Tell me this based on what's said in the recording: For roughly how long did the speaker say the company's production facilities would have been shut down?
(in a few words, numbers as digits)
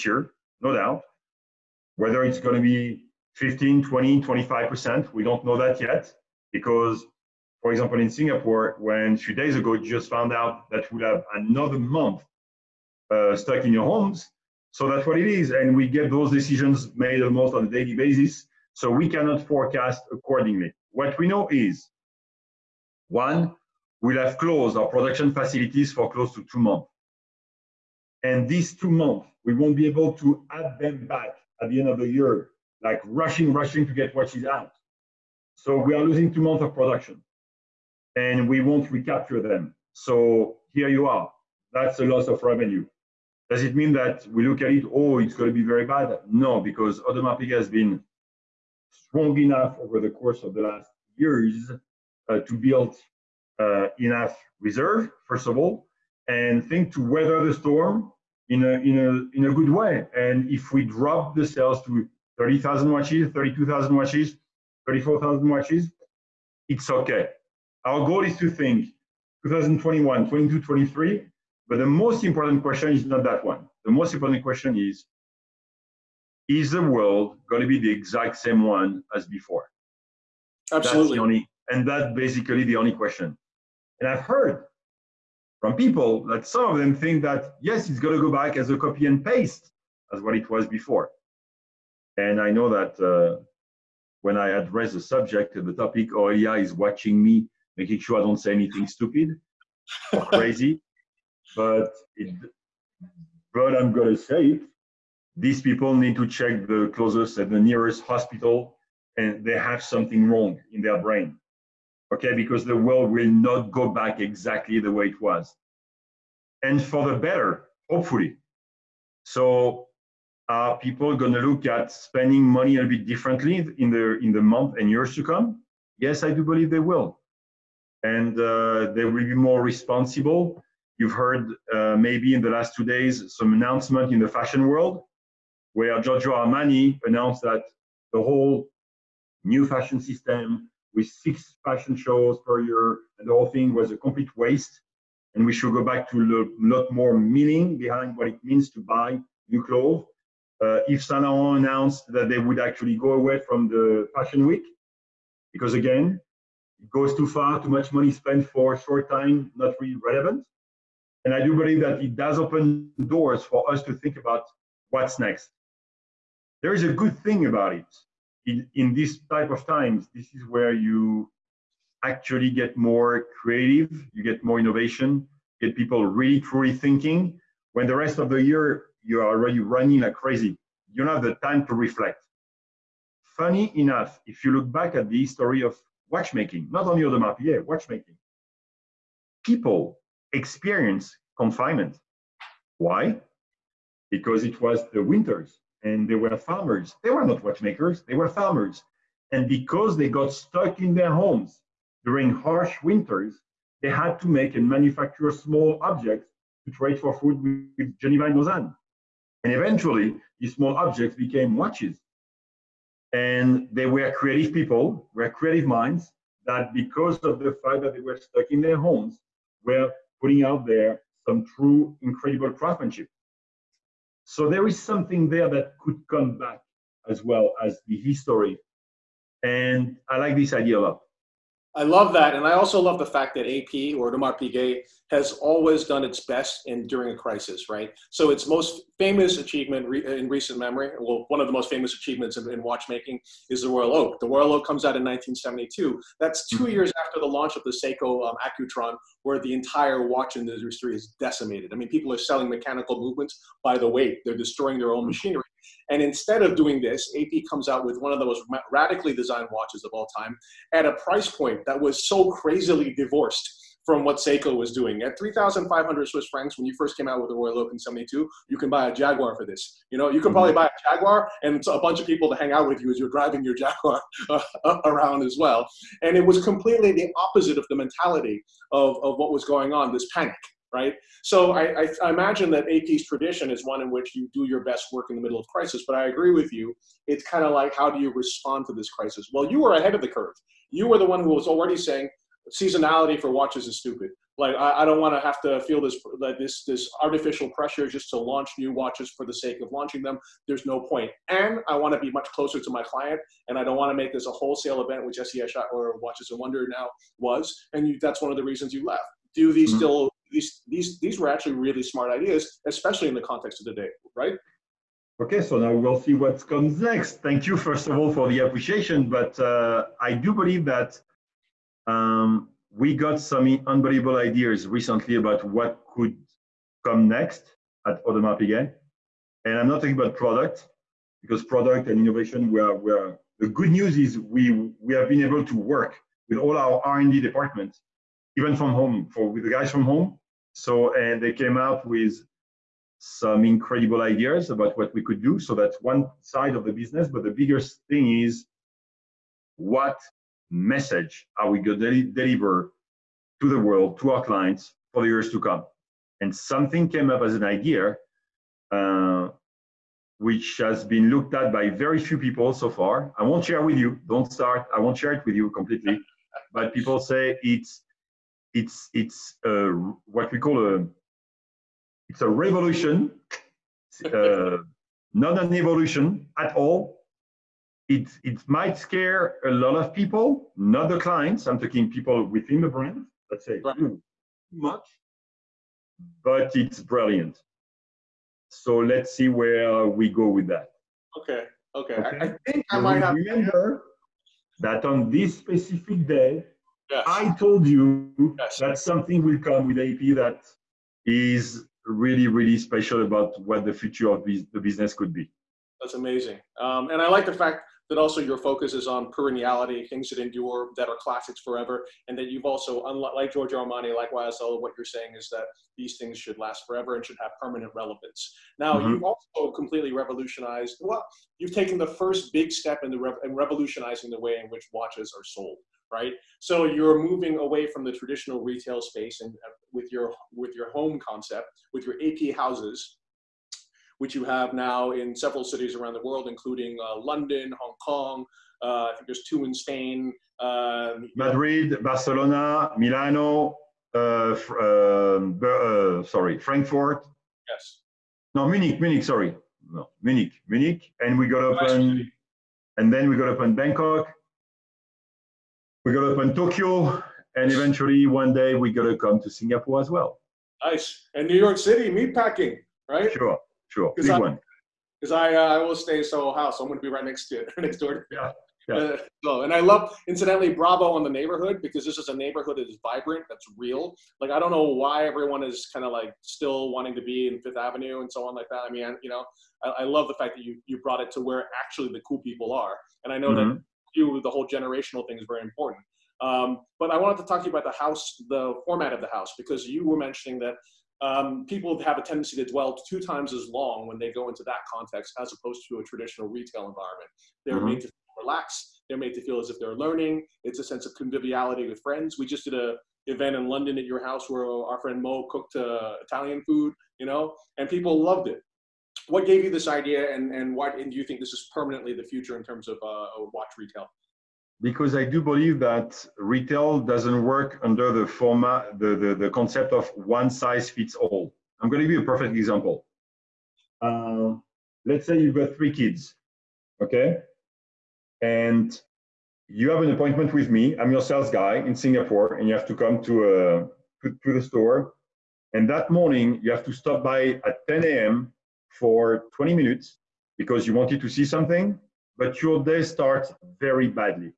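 Close to two months.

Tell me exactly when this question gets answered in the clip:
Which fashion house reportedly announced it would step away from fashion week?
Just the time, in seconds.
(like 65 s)
150 s.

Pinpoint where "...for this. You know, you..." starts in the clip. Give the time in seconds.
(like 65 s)
269 s.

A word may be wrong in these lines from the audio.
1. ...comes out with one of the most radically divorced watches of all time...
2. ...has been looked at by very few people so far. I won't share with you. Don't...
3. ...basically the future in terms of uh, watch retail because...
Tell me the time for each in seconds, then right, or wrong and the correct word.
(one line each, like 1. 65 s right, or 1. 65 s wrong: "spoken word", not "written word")
1. 257 s wrong: "designed", not "divorced"
2. 360 s right
3. 511 s wrong: "permanently", not "basically".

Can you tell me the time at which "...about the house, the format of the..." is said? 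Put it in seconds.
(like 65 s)
487 s.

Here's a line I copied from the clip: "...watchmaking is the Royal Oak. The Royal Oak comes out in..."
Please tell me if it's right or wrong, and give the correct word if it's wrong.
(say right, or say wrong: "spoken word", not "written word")
right.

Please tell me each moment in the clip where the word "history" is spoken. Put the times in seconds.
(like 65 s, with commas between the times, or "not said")
185 s, 227 s.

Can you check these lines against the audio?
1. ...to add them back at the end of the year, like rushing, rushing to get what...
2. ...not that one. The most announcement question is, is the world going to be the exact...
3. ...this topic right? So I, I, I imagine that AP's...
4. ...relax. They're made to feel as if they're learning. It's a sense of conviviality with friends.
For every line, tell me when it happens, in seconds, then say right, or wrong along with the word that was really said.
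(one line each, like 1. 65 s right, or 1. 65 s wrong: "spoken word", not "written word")
1. 30 s right
2. 73 s wrong: "important", not "announcement"
3. 279 s wrong: "panic", not "topic"
4. 498 s right.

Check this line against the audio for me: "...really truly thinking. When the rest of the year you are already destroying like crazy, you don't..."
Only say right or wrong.
wrong.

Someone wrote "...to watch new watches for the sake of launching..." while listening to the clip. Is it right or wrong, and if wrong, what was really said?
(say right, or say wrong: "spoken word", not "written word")
wrong: "launch", not "watch".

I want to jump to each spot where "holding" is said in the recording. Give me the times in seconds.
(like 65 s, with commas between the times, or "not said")
not said.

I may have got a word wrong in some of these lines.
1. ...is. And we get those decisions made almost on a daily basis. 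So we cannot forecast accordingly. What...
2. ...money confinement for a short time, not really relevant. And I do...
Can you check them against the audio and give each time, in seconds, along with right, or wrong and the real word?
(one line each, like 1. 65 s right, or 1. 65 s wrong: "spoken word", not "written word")
1. 15 s right
2. 157 s wrong: "spent", not "confinement".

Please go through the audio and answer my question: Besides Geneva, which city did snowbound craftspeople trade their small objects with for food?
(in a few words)
Lausanne.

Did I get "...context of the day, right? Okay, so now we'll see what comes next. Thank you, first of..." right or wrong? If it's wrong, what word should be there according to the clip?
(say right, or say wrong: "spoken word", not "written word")
right.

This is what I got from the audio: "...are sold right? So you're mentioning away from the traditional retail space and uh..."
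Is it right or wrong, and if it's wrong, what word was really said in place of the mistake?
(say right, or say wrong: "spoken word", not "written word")
wrong: "moving", not "mentioning".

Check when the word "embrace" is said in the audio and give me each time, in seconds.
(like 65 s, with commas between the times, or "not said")
not said.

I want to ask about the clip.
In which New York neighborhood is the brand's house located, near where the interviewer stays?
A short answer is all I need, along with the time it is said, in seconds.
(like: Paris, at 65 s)
Meatpacking, at 461 s.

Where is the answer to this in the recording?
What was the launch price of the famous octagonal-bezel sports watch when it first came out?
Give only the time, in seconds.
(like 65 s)
265 s.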